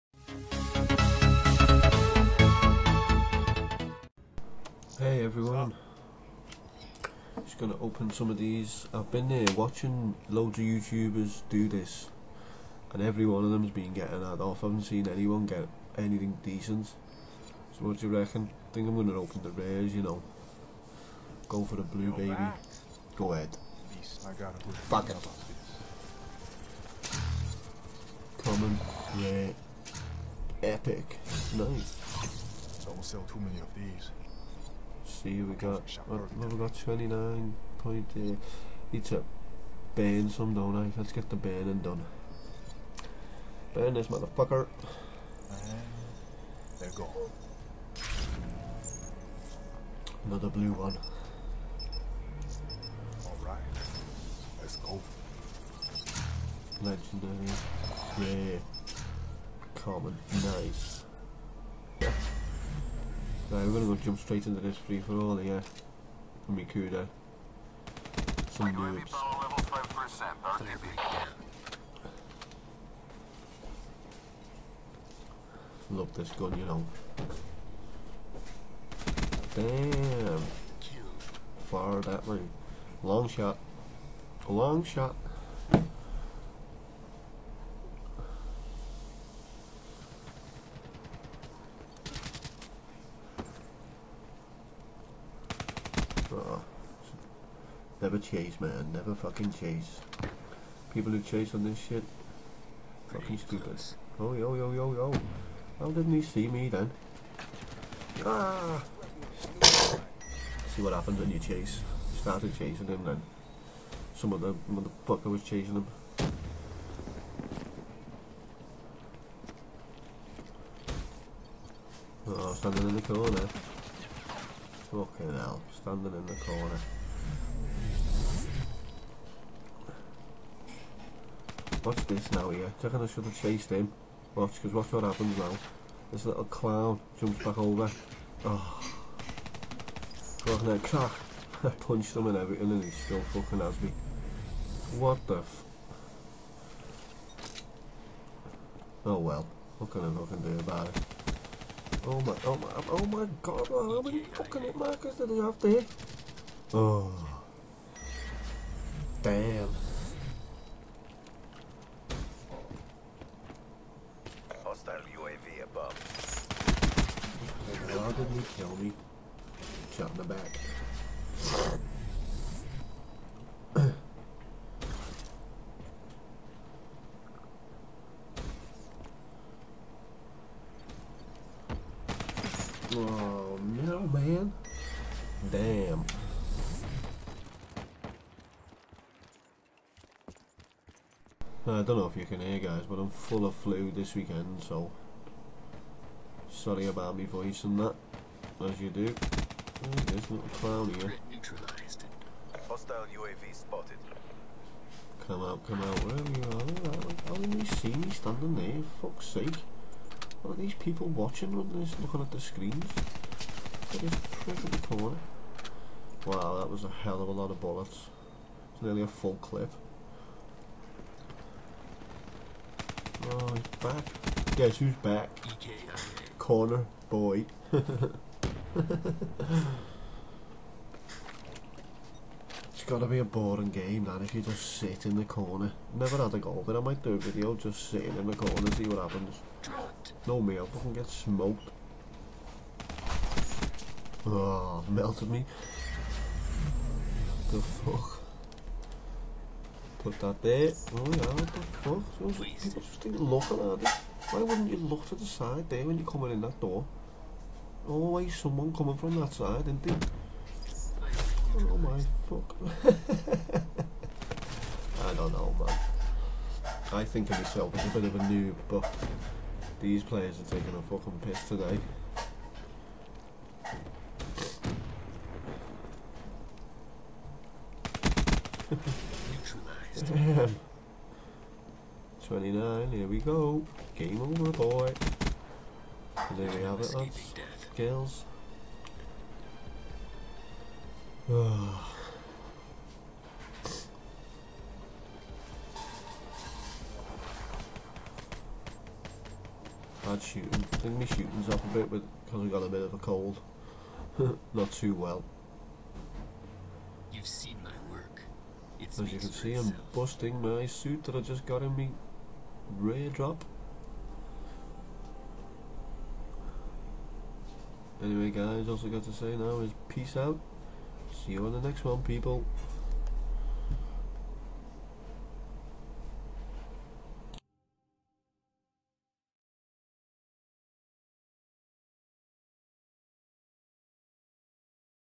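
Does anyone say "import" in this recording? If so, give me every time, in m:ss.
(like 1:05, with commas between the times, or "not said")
not said.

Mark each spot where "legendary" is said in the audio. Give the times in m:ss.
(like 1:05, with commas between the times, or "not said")
0:56.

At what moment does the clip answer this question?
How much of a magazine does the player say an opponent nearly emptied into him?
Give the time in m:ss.
3:39.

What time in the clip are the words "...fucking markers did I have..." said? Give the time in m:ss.
2:34.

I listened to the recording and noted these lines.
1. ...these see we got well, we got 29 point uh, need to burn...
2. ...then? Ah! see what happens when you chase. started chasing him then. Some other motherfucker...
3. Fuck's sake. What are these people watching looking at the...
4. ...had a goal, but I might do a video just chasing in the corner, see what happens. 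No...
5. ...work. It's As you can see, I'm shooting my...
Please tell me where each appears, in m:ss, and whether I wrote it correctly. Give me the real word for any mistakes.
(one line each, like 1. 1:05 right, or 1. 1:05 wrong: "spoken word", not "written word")
1. 0:33 right
2. 1:46 right
3. 3:29 right
4. 3:56 wrong: "sitting", not "chasing"
5. 5:07 wrong: "busting", not "shooting".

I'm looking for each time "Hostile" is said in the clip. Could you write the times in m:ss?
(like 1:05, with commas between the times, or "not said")
2:44, 3:22.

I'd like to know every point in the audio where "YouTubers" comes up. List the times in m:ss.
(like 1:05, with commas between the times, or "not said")
0:10.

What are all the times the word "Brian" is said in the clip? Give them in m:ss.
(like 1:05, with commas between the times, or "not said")
not said.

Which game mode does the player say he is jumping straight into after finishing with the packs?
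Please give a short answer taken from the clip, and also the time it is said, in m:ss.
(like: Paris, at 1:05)
free for all, at 1:04.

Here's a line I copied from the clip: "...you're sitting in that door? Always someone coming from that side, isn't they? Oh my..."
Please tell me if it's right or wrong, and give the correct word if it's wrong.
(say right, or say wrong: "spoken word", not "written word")
wrong: "coming", not "sitting".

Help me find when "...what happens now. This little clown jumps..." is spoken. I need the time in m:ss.
2:14.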